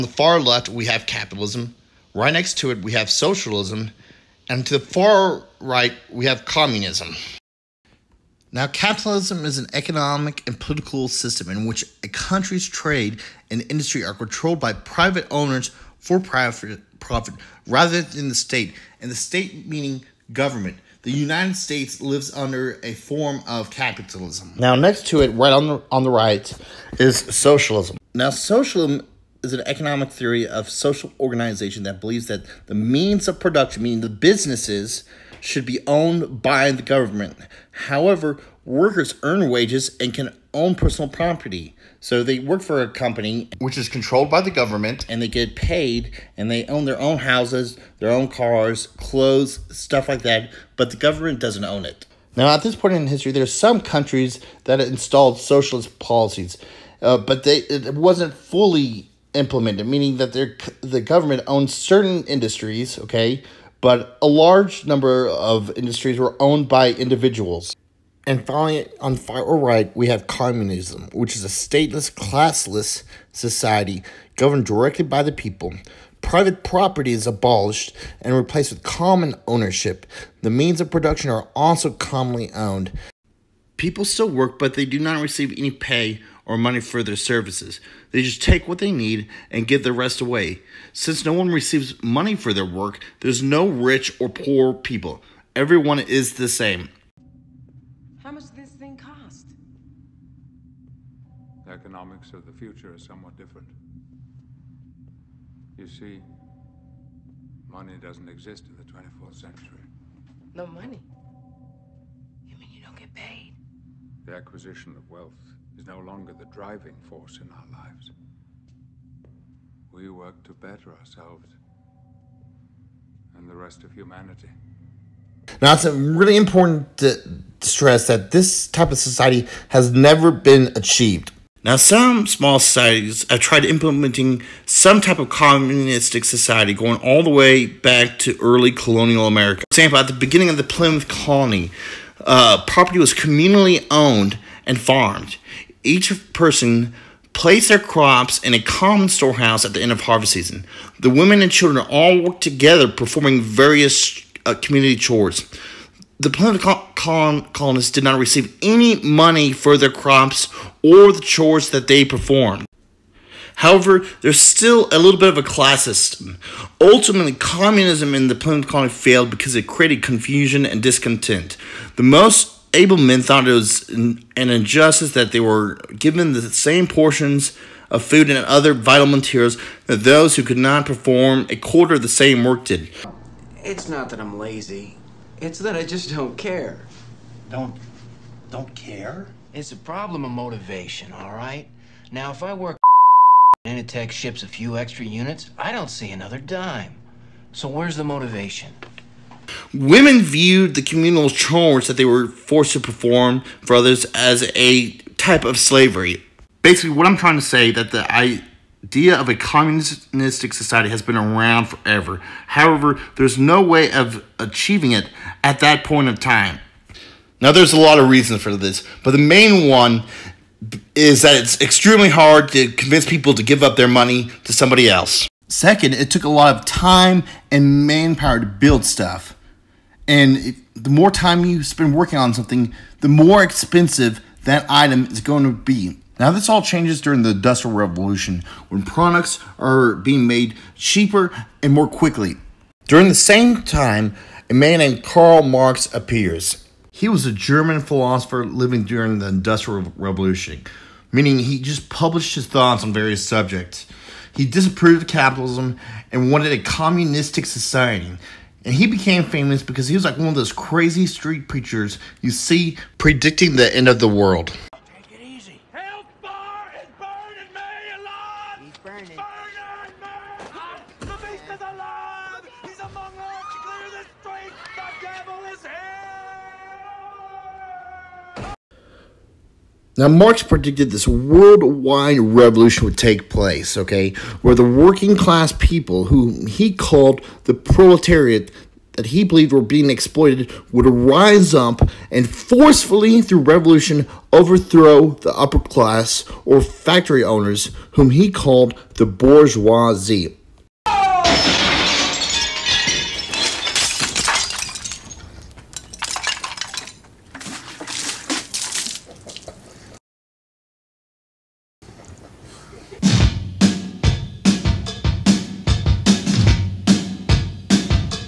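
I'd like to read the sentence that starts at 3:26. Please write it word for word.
Basically, what I'm trying to say that the idea of a communistic society has been around forever.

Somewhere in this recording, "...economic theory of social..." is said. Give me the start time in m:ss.
0:29.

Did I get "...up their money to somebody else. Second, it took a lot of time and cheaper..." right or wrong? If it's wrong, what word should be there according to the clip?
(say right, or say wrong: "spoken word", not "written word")
wrong: "manpower", not "cheaper".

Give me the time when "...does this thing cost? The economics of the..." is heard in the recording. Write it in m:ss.
1:38.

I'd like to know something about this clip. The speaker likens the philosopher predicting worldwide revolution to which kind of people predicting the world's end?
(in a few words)
crazy street preachers.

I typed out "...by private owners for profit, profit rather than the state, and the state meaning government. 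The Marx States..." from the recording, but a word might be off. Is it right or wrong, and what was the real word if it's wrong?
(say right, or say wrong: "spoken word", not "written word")
wrong: "United", not "Marx".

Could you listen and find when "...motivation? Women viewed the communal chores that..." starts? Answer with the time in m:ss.
3:18.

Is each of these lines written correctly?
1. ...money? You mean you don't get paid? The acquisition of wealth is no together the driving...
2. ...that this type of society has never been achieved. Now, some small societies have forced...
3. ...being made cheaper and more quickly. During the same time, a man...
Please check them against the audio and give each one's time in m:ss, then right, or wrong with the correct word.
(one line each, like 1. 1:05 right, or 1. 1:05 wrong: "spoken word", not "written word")
1. 1:50 wrong: "longer", not "together"
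2. 2:08 wrong: "tried", not "forced"
3. 3:59 right.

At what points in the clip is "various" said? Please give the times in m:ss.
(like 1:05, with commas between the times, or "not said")
2:33, 4:12.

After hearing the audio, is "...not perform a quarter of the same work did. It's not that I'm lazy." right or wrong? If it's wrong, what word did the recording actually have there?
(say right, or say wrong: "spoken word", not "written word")
right.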